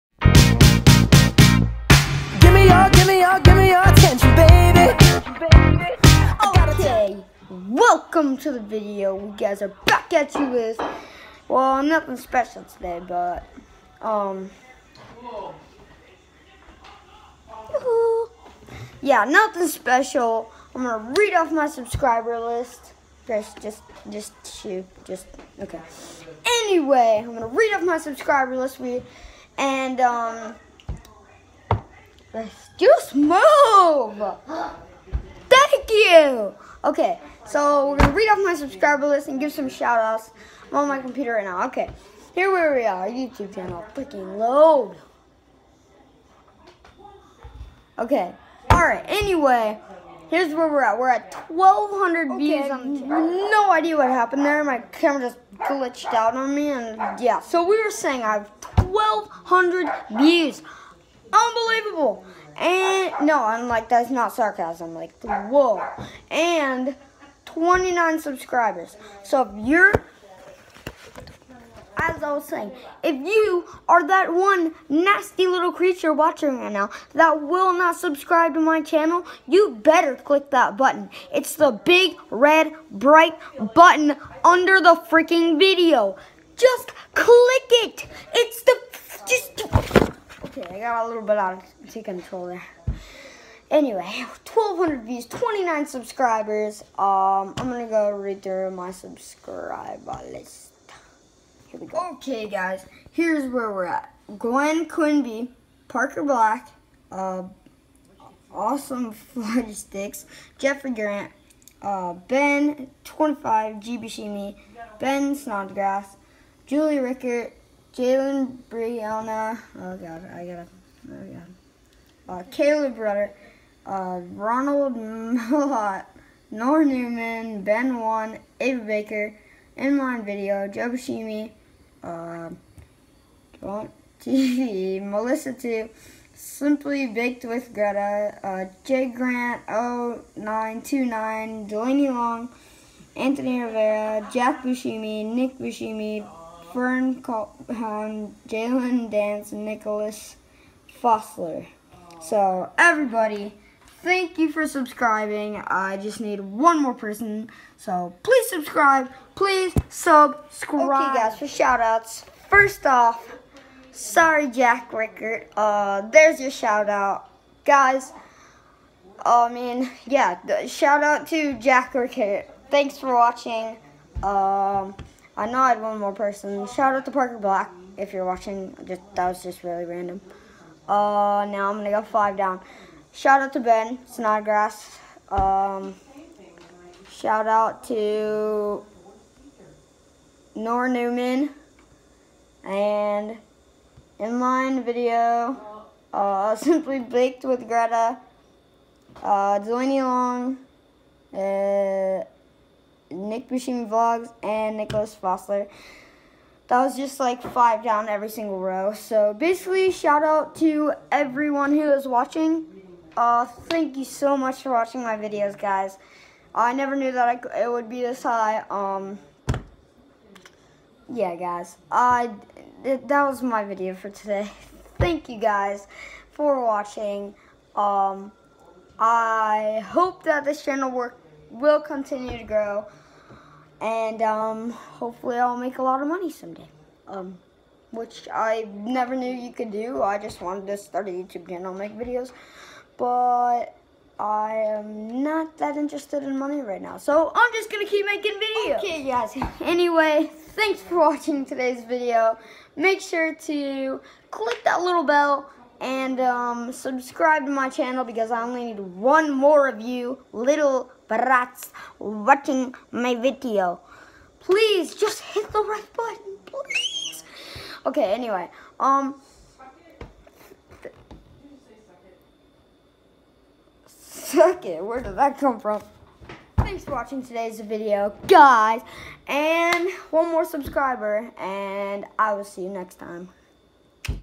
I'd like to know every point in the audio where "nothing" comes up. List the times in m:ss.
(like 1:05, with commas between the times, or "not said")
0:11, 0:19.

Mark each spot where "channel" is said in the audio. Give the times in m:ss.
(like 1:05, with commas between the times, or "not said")
0:43, 1:18, 3:50, 4:01, 4:17.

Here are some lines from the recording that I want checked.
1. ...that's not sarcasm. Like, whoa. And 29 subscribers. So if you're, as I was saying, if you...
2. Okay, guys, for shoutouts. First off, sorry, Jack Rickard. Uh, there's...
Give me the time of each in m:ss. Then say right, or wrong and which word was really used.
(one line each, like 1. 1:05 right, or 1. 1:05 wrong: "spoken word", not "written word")
1. 1:03 right
2. 2:41 right.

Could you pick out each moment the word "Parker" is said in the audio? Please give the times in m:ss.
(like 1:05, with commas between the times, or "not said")
1:45, 2:57.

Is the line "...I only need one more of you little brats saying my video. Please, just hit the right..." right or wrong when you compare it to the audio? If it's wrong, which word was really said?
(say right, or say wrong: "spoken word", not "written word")
wrong: "watching", not "saying".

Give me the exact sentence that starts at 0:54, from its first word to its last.
My camera just glitched out on me, and yeah.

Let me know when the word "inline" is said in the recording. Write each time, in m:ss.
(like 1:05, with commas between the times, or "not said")
2:09, 3:14.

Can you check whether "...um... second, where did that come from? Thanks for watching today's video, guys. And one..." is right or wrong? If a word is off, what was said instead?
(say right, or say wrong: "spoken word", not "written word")
right.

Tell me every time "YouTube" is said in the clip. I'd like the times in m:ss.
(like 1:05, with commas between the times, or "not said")
0:43, 4:01.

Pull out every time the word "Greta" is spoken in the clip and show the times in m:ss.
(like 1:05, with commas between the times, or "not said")
2:17, 3:17.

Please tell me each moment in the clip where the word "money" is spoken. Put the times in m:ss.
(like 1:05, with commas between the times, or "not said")
3:56, 4:06.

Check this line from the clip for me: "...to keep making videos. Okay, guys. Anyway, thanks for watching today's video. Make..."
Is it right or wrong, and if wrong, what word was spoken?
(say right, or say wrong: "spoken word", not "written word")
right.